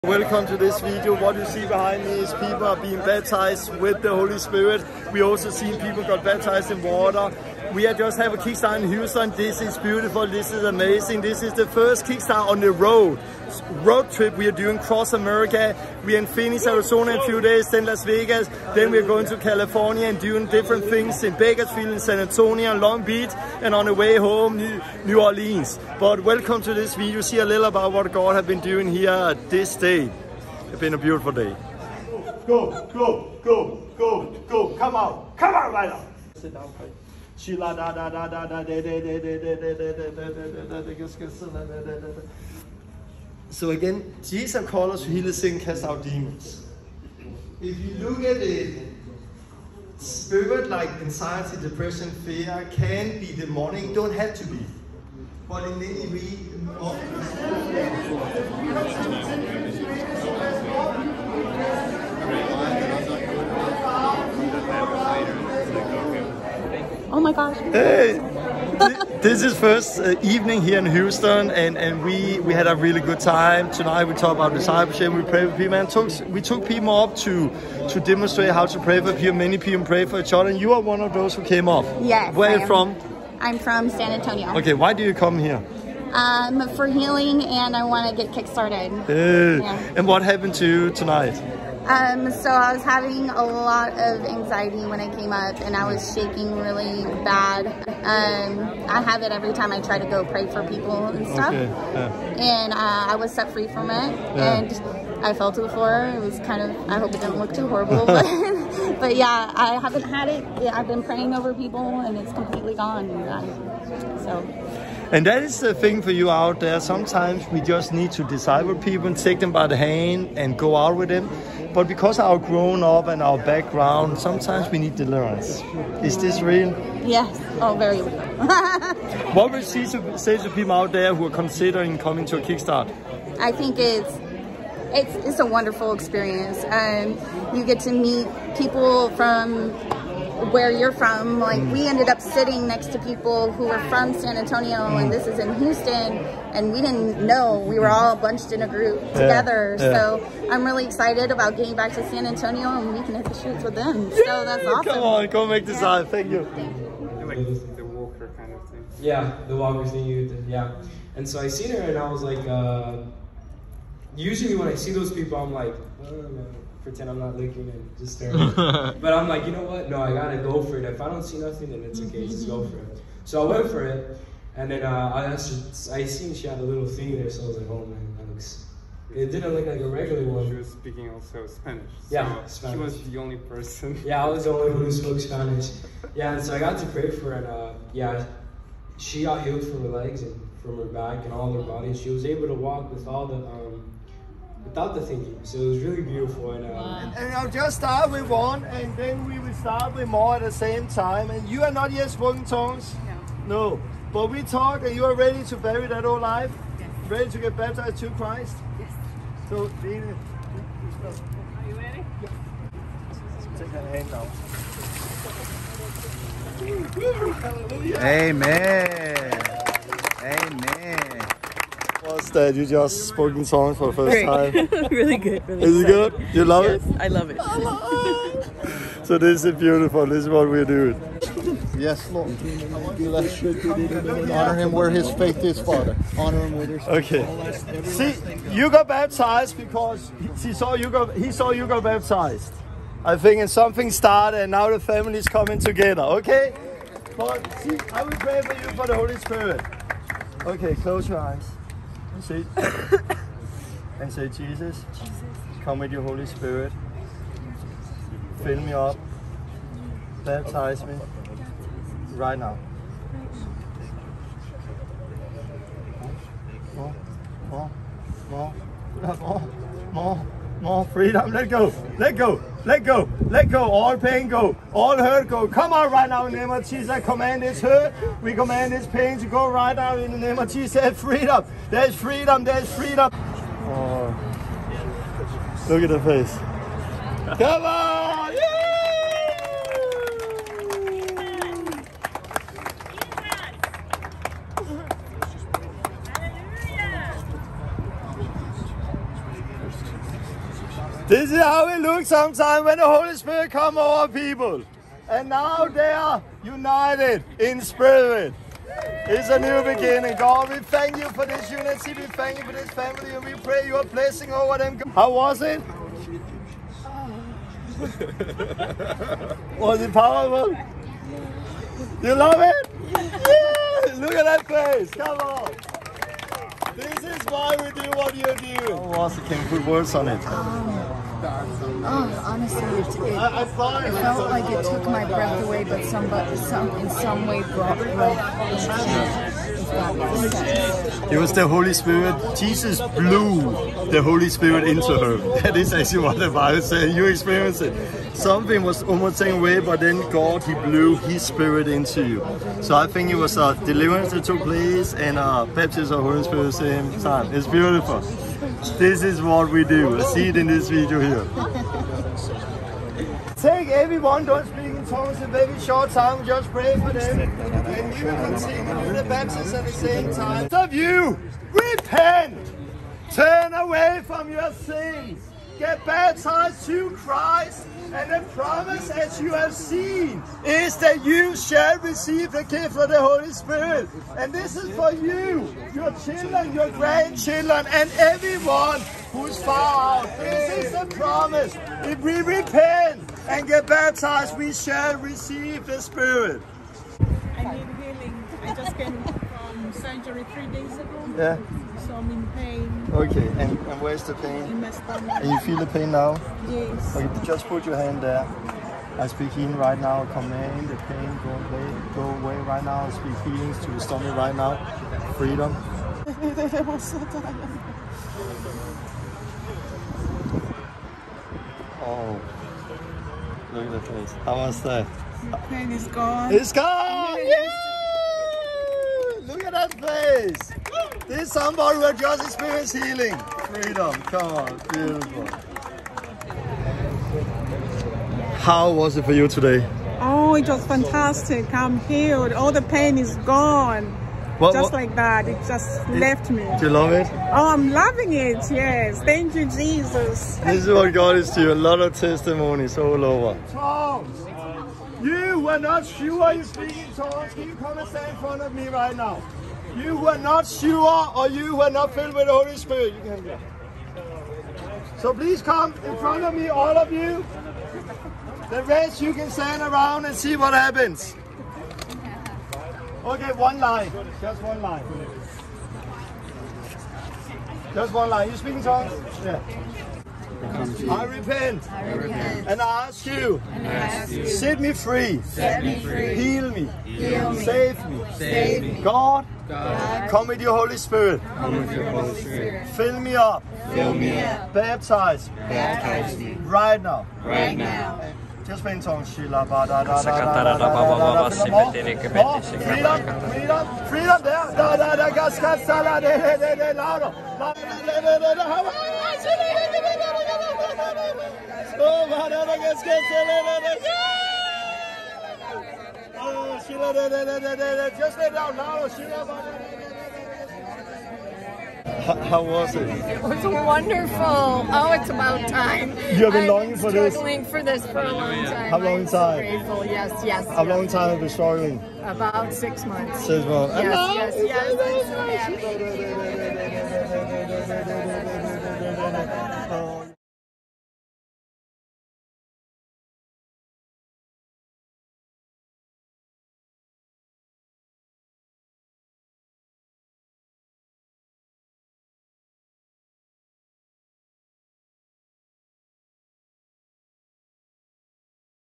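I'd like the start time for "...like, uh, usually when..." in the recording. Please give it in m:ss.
2:42.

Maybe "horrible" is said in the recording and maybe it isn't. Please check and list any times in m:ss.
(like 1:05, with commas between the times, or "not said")
1:47.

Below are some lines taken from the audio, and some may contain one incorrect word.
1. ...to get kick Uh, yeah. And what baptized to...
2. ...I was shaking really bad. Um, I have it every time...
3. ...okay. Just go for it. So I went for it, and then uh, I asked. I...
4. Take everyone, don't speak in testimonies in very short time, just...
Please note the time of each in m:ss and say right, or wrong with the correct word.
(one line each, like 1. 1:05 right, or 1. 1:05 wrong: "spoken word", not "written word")
1. 1:28 wrong: "happened", not "baptized"
2. 1:35 right
3. 2:52 right
4. 6:03 wrong: "tongues", not "testimonies".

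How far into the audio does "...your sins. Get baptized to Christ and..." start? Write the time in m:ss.
6:14.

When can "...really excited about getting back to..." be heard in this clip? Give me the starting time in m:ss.
2:30.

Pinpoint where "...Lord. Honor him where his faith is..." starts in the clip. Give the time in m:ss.
3:52.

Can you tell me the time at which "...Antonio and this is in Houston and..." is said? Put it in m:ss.
2:24.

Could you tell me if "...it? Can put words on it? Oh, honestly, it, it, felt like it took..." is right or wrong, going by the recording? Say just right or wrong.
right.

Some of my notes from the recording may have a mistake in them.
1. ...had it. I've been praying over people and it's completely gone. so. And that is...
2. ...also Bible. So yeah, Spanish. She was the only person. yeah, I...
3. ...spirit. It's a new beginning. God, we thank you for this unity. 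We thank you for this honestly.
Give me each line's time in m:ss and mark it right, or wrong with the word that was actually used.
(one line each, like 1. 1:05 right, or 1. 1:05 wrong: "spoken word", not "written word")
1. 1:50 right
2. 3:01 wrong: "Spanish", not "Bible"
3. 5:07 wrong: "family", not "honestly".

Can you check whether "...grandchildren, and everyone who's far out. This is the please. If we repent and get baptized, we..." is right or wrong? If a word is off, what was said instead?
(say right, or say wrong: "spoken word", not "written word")
wrong: "promise", not "please".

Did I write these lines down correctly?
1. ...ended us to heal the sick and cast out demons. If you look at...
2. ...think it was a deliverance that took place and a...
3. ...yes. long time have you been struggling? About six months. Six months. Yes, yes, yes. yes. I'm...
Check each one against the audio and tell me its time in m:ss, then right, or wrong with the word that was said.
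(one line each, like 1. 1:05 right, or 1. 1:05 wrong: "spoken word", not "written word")
1. 0:44 wrong: "called", not "ended"
2. 5:52 right
3. 8:50 right.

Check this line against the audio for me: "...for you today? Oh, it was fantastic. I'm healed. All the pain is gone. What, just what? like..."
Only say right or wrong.
right.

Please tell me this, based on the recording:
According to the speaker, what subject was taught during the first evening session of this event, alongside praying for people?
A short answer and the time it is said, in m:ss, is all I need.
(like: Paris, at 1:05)
Discipleship, at 1:14.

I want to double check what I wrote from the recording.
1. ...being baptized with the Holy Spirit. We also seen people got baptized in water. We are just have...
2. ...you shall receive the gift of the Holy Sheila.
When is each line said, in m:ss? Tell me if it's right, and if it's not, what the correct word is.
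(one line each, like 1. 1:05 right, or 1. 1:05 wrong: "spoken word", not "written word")
1. 0:02 right
2. 6:21 wrong: "Spirit", not "Sheila".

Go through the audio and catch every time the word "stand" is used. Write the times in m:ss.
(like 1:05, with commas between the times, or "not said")
7:37, 7:49.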